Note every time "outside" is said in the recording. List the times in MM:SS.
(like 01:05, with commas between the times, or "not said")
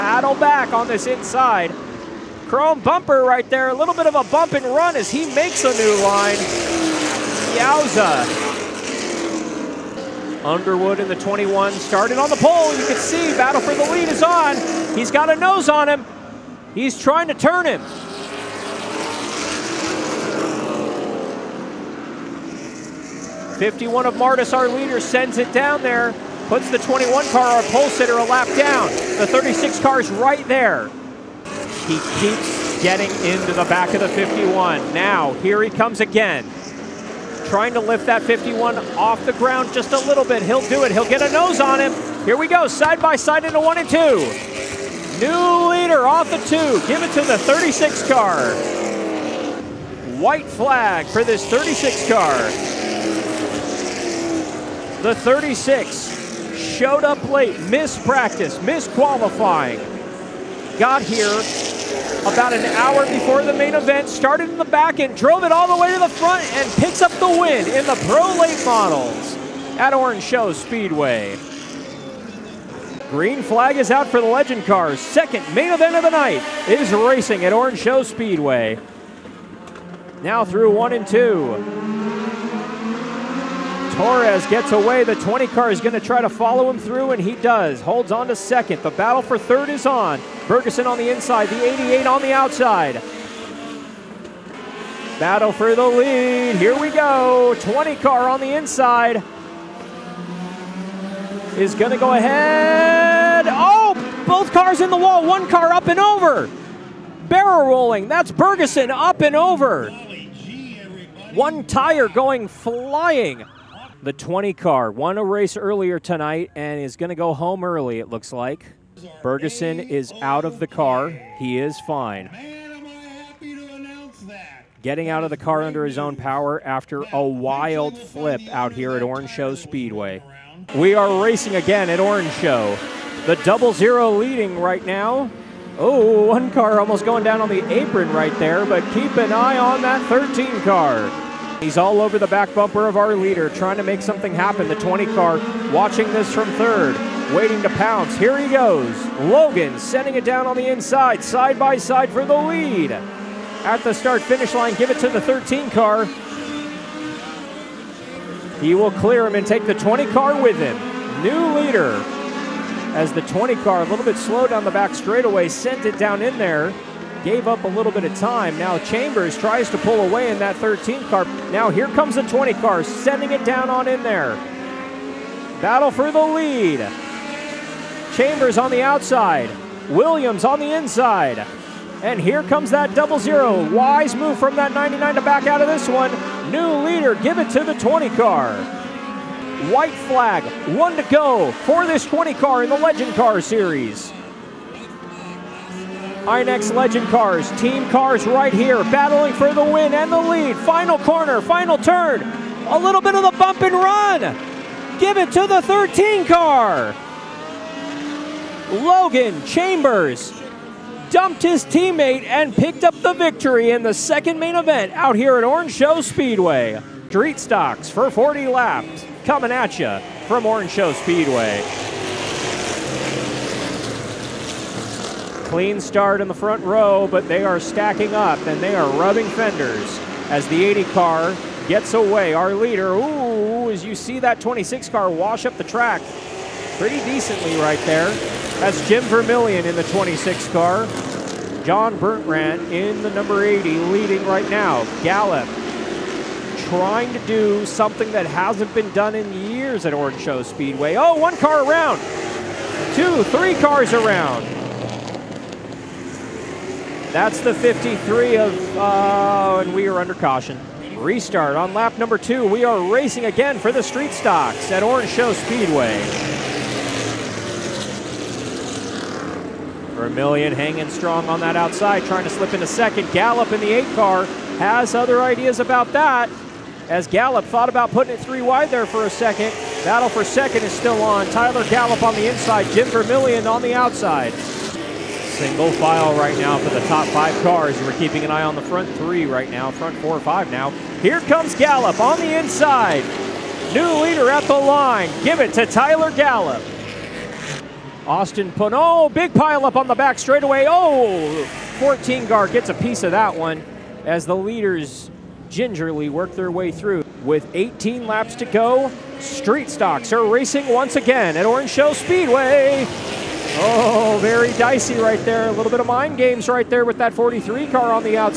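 01:32, 02:58, 04:31, 04:43.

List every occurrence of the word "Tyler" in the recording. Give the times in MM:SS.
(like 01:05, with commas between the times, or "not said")
04:41, 04:55.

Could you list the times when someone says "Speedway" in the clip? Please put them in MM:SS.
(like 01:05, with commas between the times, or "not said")
01:10, 01:18, 02:09, 03:35, 03:40, 04:10, 04:25, 05:11.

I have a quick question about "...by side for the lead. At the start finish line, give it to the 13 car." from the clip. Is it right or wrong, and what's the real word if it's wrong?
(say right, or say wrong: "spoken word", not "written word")
right.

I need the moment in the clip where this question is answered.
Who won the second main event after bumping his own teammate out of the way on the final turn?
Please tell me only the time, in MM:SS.
03:28.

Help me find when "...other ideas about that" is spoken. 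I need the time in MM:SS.
04:34.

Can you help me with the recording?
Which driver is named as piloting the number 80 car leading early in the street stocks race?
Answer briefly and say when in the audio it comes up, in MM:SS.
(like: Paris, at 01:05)
John Bertrand, at 04:01.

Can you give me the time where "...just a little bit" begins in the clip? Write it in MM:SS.
00:39.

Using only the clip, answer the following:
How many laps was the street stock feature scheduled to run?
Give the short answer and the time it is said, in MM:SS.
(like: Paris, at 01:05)
40, at 03:38.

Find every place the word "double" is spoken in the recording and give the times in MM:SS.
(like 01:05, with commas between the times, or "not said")
02:13, 03:02.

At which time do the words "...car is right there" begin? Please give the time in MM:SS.
00:29.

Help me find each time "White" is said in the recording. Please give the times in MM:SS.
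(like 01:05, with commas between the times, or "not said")
00:50, 03:09.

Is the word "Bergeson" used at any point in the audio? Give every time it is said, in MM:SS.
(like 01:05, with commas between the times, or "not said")
01:48, 01:59.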